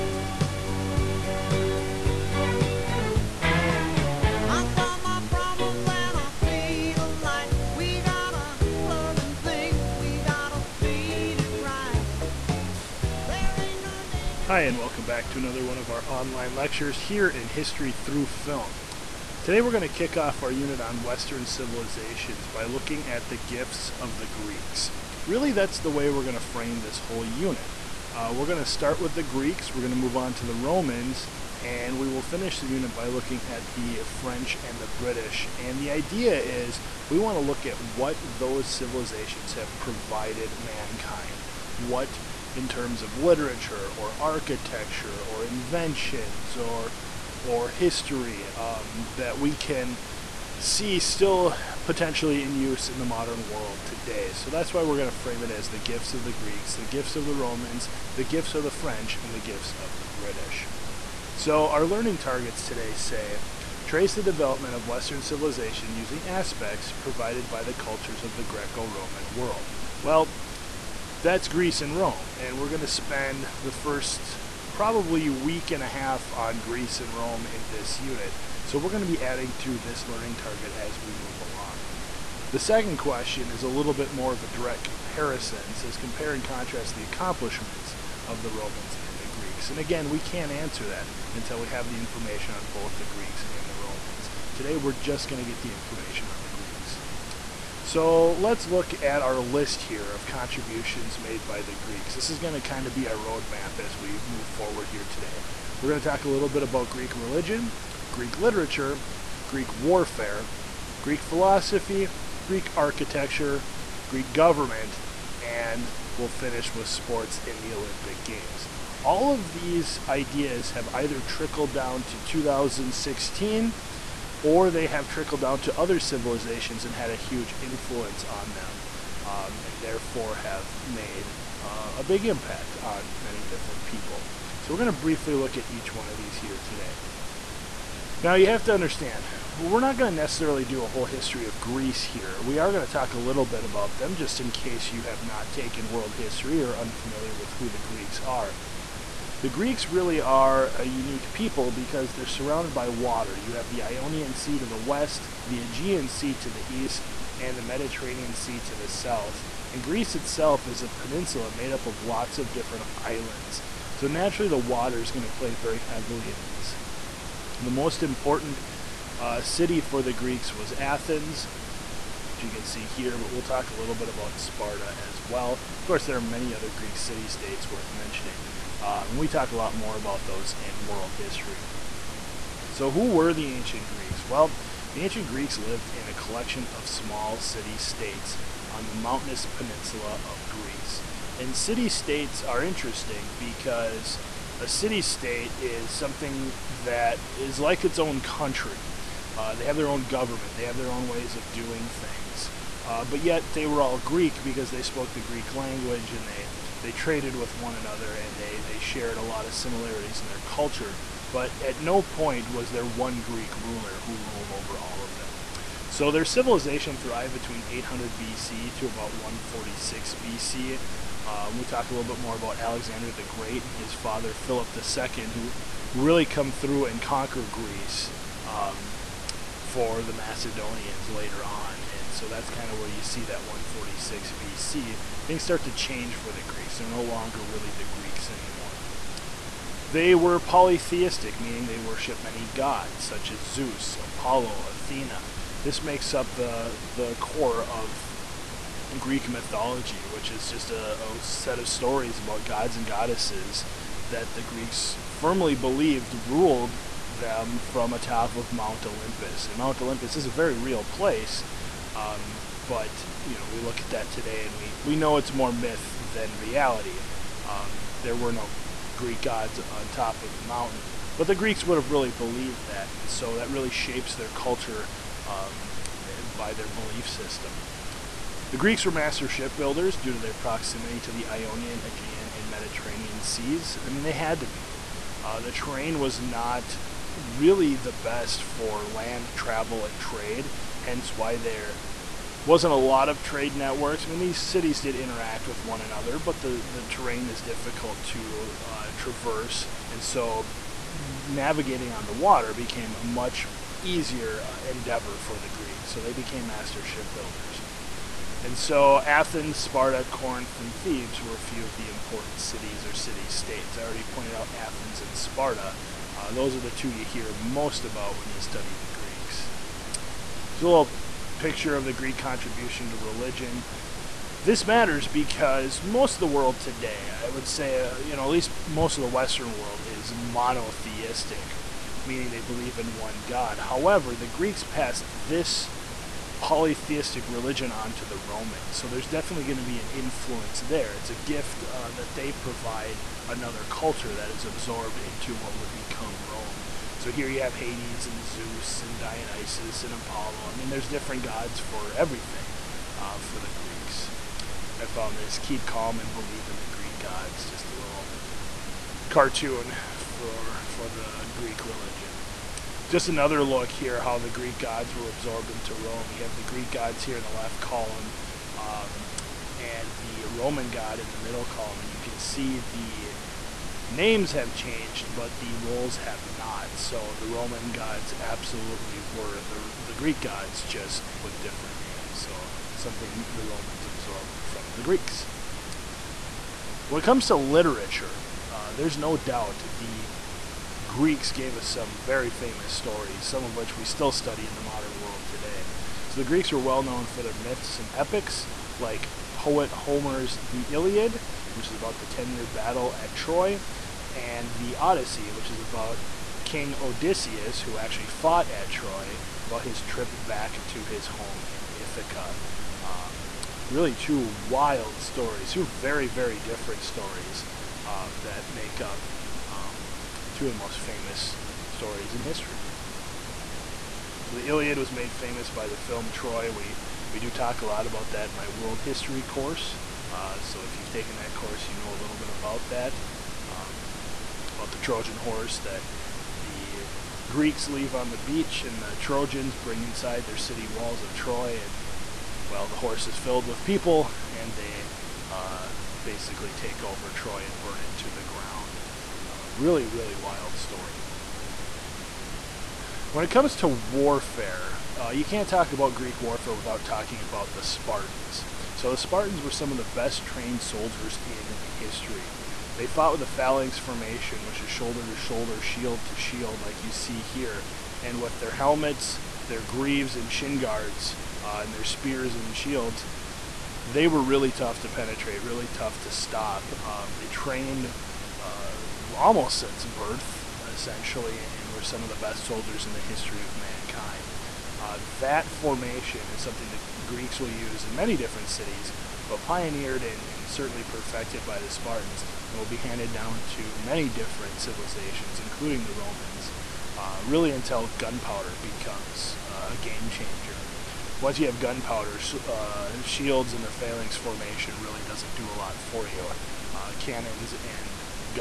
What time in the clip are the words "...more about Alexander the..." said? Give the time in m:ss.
3:42.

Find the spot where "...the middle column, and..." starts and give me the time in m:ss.
6:11.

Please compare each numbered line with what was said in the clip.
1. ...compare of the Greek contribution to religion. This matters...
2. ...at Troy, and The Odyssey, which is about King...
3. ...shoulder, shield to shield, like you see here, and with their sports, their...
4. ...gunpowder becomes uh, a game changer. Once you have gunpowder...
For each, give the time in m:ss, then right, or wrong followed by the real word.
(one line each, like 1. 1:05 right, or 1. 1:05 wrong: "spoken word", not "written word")
1. 5:21 wrong: "picture", not "compare"
2. 6:42 right
3. 7:45 wrong: "helmets", not "sports"
4. 8:17 right.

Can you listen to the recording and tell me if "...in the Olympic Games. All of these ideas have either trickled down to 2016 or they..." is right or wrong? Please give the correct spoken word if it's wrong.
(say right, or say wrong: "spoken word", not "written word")
right.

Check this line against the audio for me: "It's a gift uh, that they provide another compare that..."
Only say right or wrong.
wrong.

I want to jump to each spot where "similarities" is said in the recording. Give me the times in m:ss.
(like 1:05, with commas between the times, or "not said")
3:29.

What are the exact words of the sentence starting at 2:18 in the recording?
Now you have to understand, we're not going to necessarily do a whole history of Greece here.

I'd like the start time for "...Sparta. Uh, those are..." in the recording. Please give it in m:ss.
5:15.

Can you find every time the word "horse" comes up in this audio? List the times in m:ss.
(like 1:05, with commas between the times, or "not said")
7:15, 7:22.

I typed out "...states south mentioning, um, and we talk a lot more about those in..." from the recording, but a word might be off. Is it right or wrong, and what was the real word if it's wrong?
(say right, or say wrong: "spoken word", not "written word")
wrong: "worth", not "south".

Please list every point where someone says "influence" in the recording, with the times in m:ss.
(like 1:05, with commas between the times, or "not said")
2:07, 5:39.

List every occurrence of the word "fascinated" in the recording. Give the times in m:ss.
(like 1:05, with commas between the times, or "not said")
not said.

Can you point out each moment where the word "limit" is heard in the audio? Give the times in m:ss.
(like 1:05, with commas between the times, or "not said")
not said.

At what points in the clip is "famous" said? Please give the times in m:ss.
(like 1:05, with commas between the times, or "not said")
6:32, 7:00, 7:05.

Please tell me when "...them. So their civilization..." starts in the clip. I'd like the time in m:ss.
3:35.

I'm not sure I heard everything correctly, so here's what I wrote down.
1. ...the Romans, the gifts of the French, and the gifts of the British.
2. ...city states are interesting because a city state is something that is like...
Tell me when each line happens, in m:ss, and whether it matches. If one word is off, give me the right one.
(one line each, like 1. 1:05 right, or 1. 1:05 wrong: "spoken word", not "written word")
1. 0:57 right
2. 3:11 right.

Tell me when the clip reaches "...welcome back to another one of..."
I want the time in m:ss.
0:14.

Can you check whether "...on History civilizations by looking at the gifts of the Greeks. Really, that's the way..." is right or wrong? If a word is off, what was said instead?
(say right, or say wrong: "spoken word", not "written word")
wrong: "Western", not "History".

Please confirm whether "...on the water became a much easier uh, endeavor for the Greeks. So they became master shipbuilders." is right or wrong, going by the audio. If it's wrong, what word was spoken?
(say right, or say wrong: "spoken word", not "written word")
right.